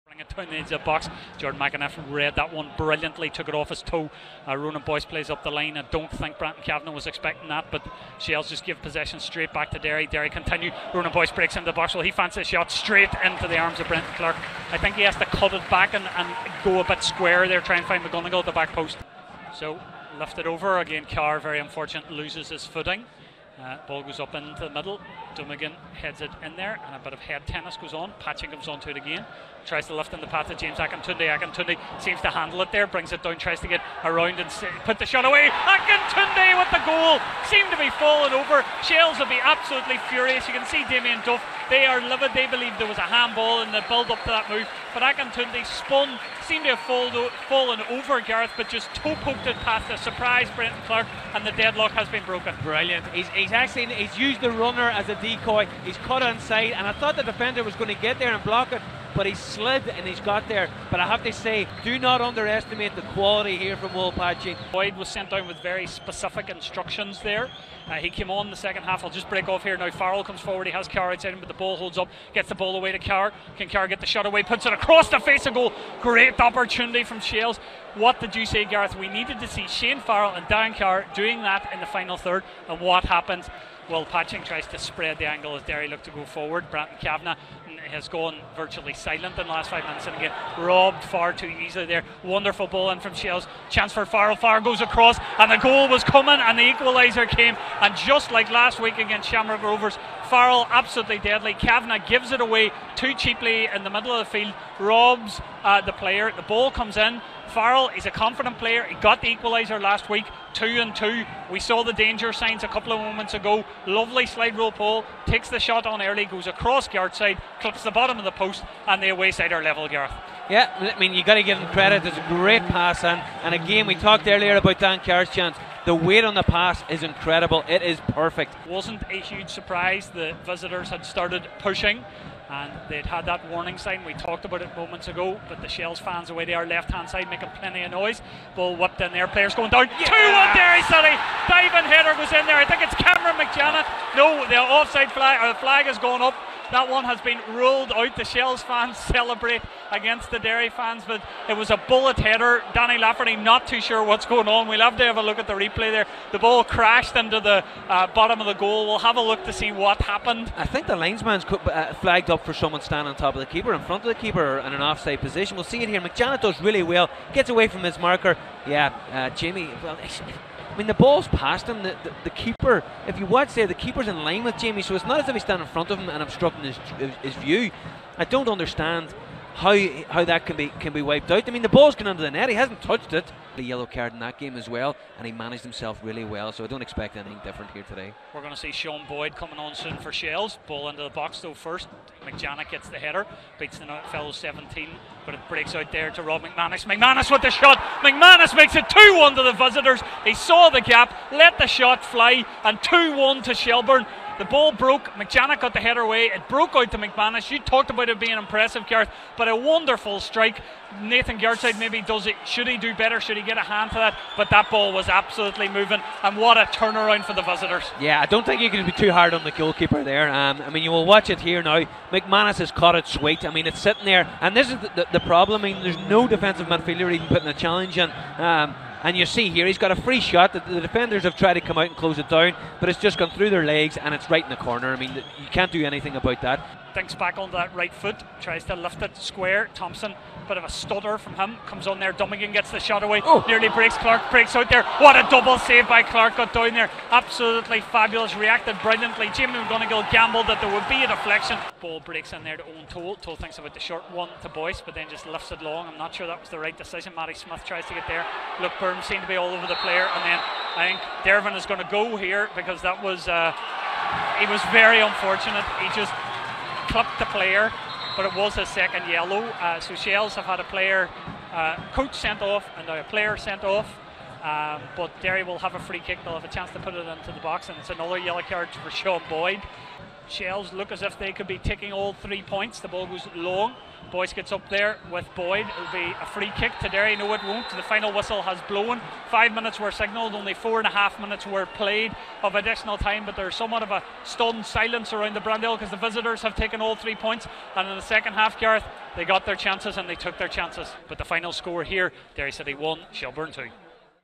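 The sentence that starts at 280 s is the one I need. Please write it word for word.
Shels look as if they could be taking all three points.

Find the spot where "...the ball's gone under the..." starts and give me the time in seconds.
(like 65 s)
181 s.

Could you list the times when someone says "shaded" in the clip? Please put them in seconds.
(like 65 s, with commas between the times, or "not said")
not said.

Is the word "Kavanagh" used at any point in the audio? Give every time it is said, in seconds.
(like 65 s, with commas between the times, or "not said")
6 s, 87 s, 101 s.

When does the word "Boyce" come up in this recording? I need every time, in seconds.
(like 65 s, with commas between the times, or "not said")
4 s, 11 s, 254 s, 284 s.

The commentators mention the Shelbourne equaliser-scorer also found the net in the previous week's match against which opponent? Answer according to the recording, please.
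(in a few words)
Shamrock Rovers.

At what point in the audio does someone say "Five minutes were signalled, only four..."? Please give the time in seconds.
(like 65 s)
289 s.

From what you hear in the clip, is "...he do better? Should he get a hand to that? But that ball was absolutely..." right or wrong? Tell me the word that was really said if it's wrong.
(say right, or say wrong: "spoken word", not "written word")
right.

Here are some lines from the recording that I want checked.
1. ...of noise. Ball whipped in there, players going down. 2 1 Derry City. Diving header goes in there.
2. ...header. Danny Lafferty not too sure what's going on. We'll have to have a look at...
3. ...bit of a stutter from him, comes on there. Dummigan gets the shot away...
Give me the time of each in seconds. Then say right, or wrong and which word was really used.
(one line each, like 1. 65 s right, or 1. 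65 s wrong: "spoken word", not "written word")
1. 137 s right
2. 152 s right
3. 240 s right.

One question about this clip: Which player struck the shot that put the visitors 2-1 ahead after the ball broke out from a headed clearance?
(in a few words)
Rob McManus.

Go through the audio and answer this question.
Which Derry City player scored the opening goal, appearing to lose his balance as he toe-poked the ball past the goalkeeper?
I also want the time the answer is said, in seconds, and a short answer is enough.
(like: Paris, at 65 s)
James Akintunde, at 30 s.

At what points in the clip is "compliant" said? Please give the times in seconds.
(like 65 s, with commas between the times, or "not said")
not said.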